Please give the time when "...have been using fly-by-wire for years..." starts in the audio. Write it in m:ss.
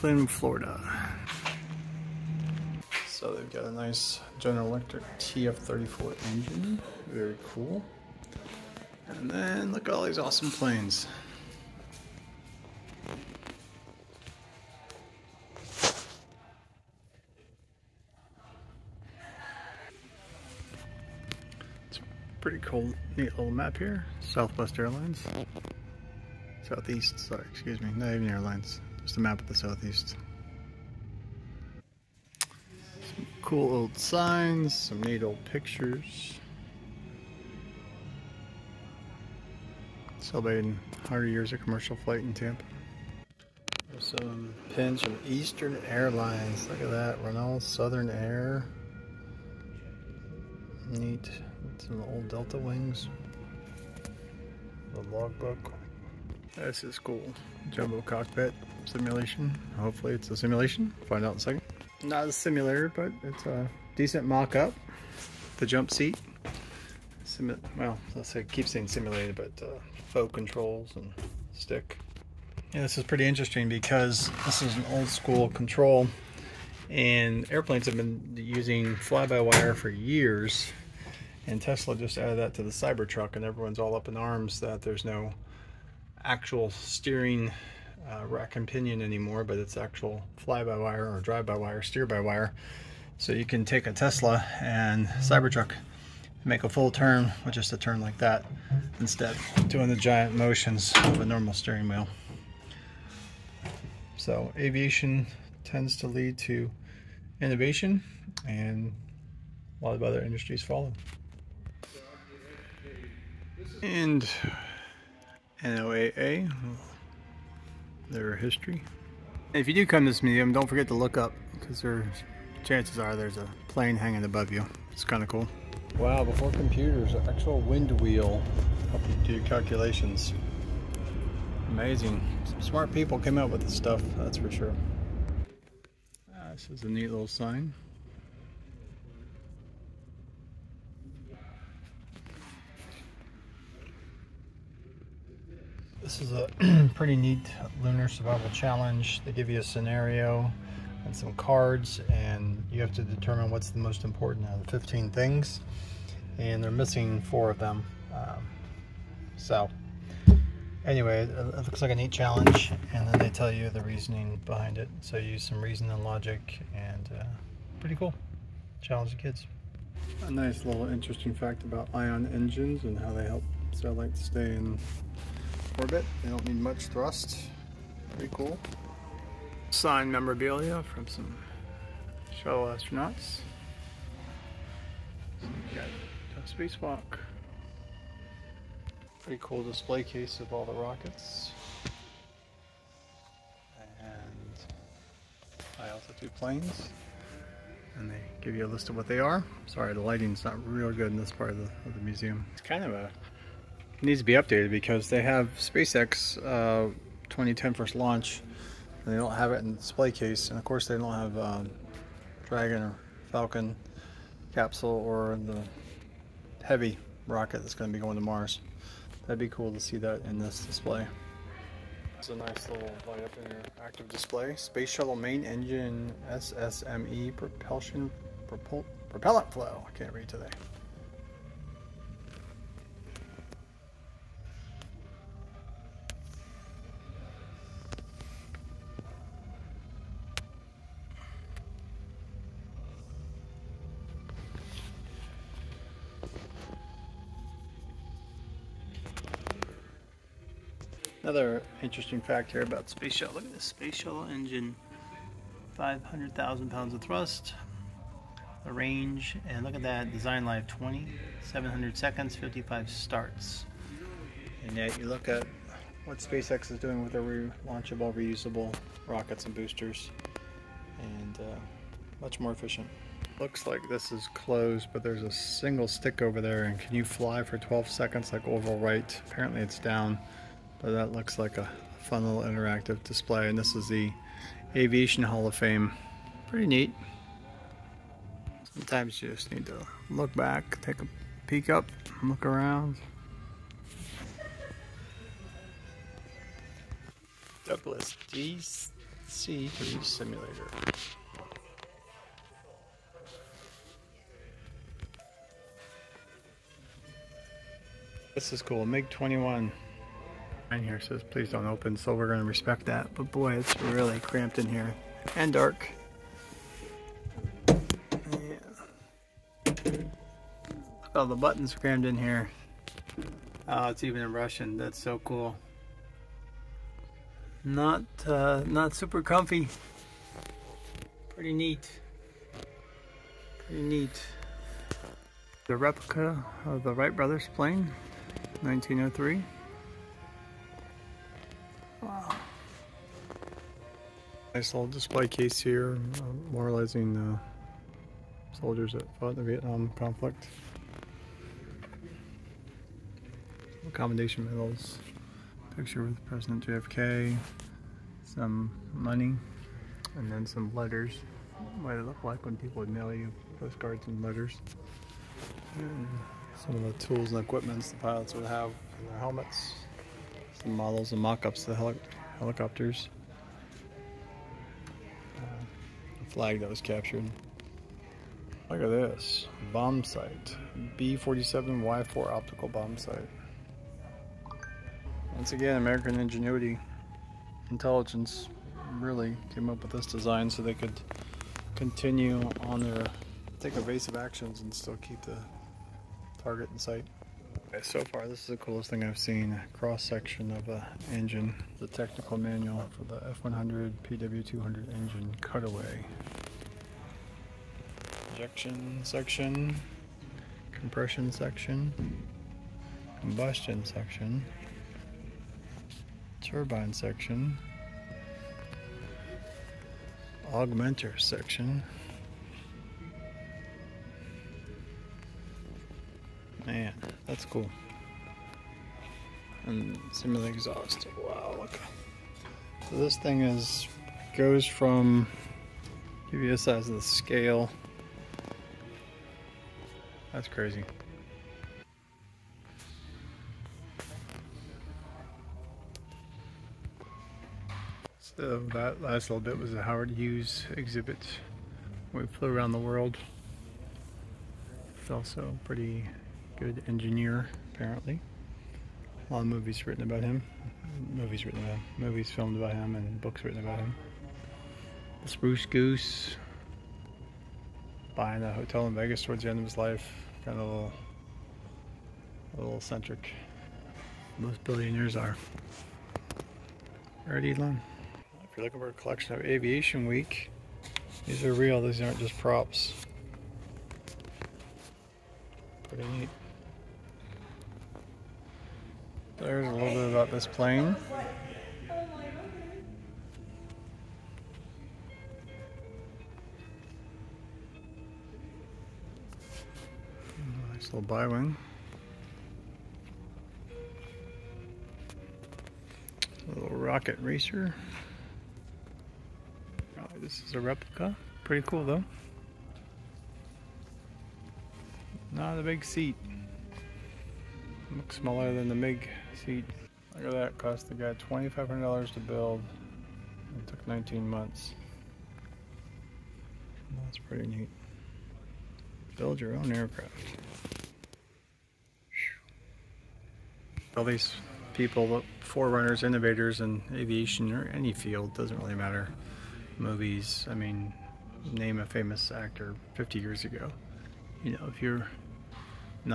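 1:17.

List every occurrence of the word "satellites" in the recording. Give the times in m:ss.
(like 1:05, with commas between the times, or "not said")
2:53.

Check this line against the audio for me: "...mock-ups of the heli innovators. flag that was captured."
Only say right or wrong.
wrong.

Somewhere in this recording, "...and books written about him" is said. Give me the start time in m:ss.
7:42.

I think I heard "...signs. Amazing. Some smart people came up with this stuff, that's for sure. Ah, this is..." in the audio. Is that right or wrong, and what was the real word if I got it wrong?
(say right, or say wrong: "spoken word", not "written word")
wrong: "calculations", not "signs".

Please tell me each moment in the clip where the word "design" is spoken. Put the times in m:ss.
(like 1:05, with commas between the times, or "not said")
4:20, 6:30.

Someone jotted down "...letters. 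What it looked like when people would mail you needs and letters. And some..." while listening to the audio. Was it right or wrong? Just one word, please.
wrong.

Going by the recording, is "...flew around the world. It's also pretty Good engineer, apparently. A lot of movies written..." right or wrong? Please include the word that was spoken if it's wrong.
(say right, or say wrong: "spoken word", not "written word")
right.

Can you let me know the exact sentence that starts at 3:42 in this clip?
It's a nice little light up in Active display.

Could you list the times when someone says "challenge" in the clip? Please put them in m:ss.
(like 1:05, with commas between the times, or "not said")
2:28, 2:42, 2:48.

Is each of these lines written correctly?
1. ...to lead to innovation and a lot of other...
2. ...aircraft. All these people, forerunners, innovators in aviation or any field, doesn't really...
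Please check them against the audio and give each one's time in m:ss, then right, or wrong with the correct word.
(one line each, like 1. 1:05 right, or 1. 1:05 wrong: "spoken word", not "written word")
1. 1:45 right
2. 8:49 right.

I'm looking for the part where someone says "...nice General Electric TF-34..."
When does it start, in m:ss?
0:03.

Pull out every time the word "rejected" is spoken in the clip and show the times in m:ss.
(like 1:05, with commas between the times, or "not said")
not said.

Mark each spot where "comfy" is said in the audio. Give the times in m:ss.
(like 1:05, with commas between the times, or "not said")
5:29.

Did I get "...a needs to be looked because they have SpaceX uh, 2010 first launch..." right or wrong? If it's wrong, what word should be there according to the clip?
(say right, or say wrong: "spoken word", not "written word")
wrong: "updated", not "looked".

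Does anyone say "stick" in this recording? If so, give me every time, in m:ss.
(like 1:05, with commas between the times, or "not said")
1:11, 4:35.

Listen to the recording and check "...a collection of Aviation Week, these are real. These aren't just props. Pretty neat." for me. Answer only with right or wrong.
right.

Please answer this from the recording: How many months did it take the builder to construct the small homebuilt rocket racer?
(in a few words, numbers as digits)
19.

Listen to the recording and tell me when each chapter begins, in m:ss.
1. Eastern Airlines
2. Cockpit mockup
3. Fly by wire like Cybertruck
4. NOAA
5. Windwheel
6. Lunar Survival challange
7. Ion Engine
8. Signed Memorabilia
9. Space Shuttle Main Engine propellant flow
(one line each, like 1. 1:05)
1. 0:26
2. 1:00
3. 1:16
4. 1:56
5. 2:08
6. 2:28
7. 2:53
8. 3:11
9. 3:44.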